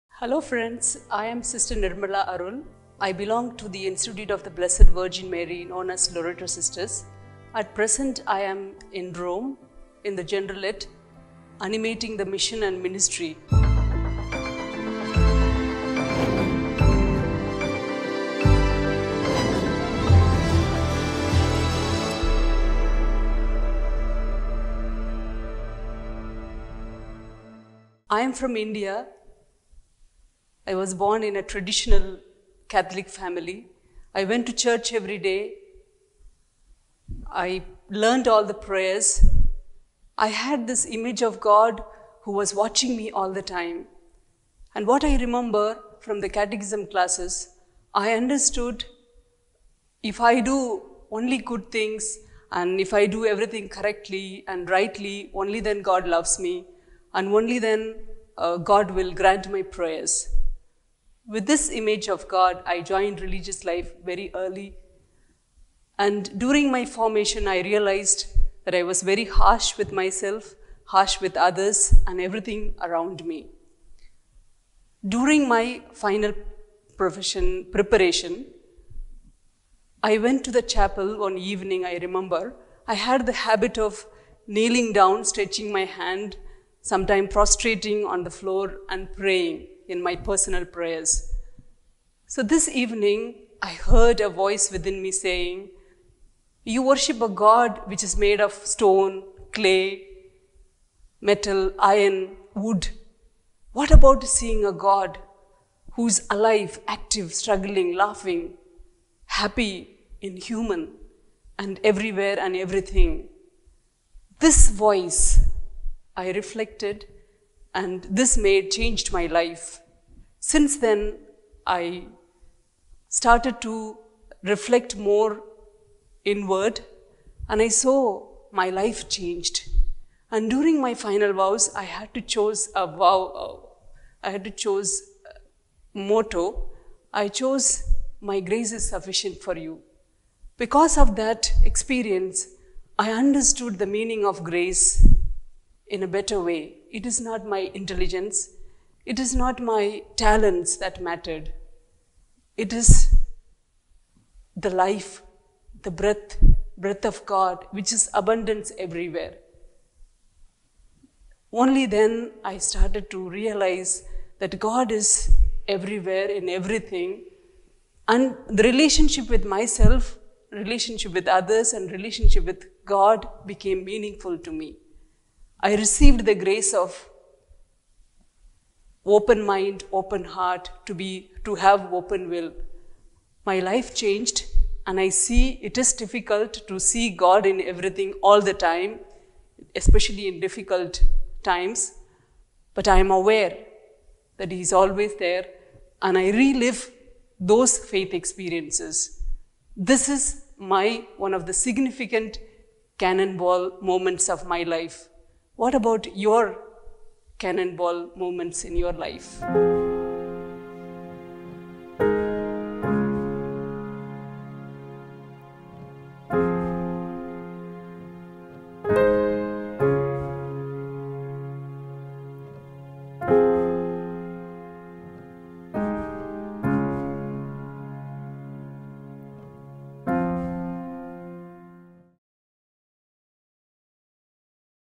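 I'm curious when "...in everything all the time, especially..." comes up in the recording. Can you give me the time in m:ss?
3:07.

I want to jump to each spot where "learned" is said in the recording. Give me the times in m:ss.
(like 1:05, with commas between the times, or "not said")
0:37.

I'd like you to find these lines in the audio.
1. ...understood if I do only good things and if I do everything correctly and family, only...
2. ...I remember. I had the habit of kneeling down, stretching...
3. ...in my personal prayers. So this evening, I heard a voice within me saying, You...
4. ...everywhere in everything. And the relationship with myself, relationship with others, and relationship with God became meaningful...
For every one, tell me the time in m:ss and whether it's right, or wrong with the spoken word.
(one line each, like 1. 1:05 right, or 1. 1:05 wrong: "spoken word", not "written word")
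1. 0:48 wrong: "rightly", not "family"
2. 1:21 right
3. 1:29 right
4. 2:45 right.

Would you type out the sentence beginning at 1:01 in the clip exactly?
With this image of God, I joined religious life very early.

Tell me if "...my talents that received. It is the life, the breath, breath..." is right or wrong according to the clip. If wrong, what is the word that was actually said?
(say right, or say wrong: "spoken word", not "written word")
wrong: "mattered", not "received".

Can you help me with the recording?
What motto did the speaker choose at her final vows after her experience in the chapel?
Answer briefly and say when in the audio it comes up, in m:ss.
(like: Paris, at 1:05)
My grace is sufficient for you, at 2:18.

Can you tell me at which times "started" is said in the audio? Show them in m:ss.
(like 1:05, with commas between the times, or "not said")
2:03, 2:42.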